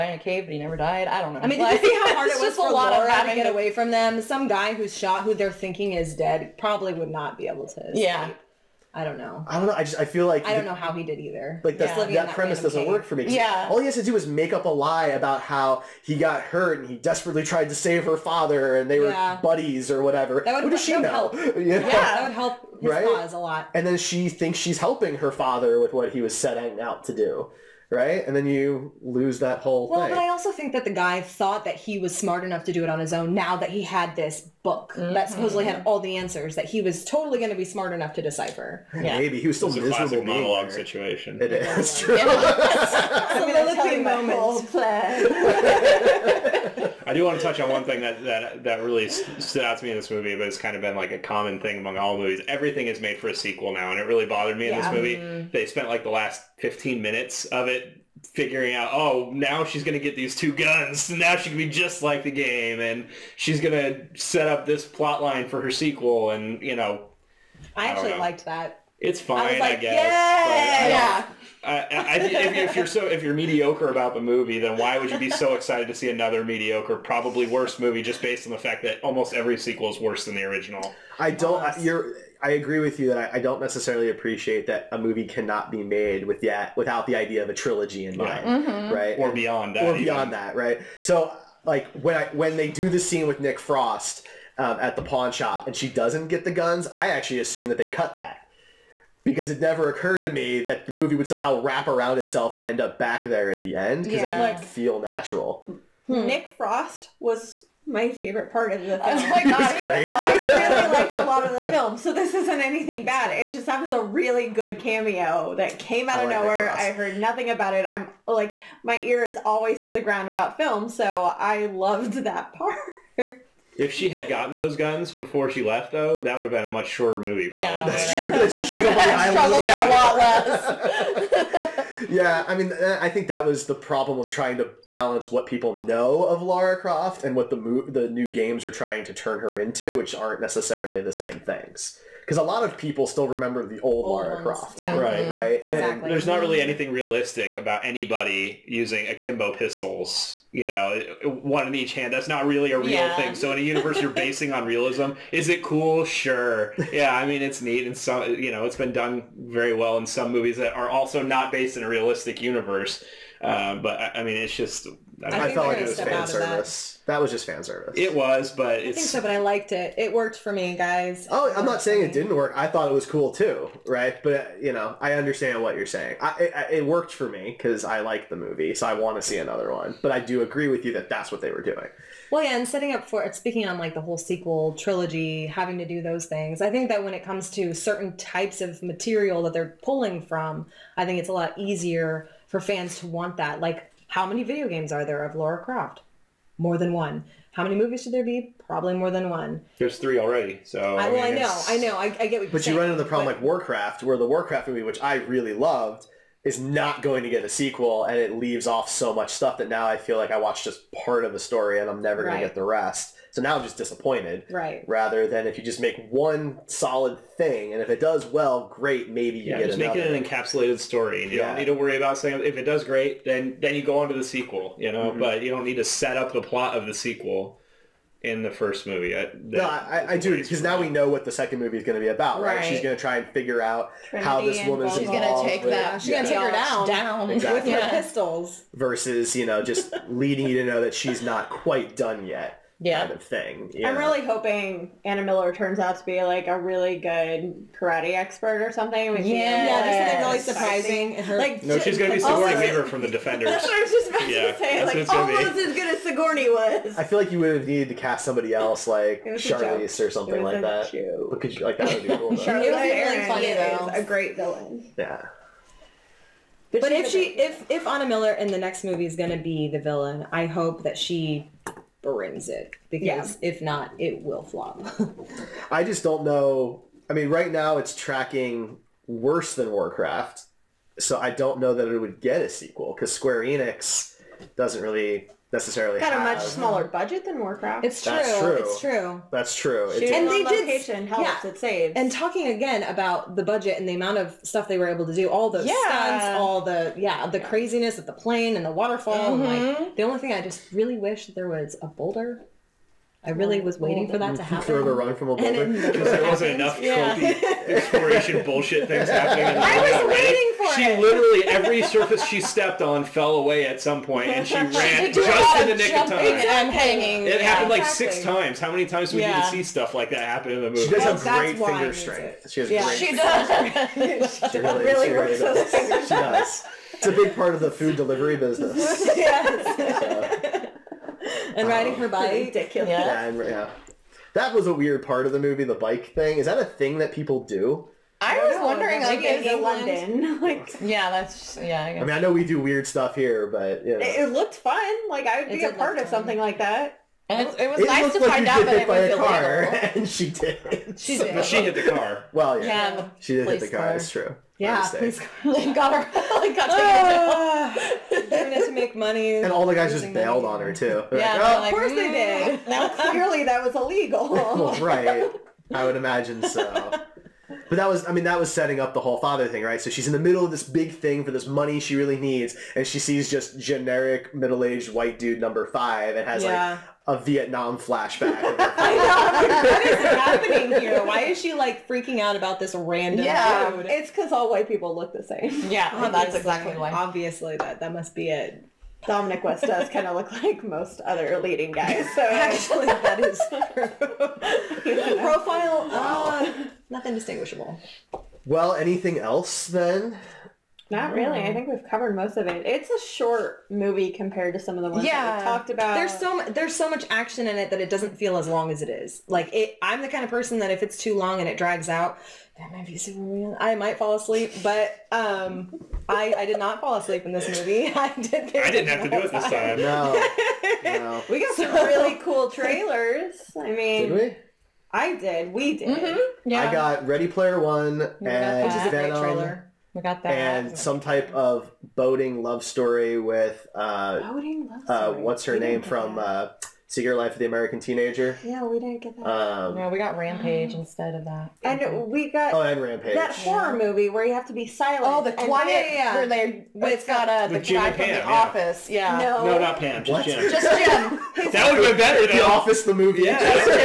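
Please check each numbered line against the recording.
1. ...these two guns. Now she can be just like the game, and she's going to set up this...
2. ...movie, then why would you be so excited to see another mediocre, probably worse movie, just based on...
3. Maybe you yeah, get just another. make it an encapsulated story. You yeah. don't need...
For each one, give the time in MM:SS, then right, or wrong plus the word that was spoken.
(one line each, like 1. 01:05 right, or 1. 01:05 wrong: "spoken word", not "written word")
1. 01:00 right
2. 01:14 right
3. 03:39 right.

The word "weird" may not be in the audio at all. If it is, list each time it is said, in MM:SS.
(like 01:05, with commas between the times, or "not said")
05:34, 05:42.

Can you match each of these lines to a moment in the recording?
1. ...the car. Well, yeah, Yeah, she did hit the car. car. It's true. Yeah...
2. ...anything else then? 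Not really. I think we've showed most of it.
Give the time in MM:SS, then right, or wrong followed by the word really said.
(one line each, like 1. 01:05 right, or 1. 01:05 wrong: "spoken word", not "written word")
1. 05:51 right
2. 06:38 wrong: "covered", not "showed".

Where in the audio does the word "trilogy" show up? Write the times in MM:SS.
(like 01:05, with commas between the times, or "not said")
01:27, 03:04.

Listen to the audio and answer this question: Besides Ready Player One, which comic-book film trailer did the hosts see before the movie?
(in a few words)
Venom.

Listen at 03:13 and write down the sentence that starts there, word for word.
Like how many video games are there of Lara Croft?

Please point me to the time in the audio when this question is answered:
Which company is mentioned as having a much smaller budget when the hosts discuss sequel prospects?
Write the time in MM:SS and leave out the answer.
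04:43.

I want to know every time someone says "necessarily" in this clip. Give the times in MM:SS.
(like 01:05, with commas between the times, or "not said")
01:23, 02:20, 04:45.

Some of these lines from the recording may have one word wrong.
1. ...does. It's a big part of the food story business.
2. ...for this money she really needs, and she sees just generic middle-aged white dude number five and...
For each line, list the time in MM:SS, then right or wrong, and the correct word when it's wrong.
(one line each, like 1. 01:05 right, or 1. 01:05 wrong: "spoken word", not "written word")
1. 05:26 wrong: "delivery", not "story"
2. 06:11 right.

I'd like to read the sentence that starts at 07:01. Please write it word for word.
we got some really cool trailers.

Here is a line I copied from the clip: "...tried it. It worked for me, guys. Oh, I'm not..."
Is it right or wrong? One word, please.
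wrong.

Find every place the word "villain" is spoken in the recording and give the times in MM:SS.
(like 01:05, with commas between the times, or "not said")
04:24, 04:29.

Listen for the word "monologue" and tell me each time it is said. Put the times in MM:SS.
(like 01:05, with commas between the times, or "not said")
00:40.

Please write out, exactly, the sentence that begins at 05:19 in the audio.
to see stuff like that happen in the movie?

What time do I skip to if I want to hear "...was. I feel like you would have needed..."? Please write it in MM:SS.
04:16.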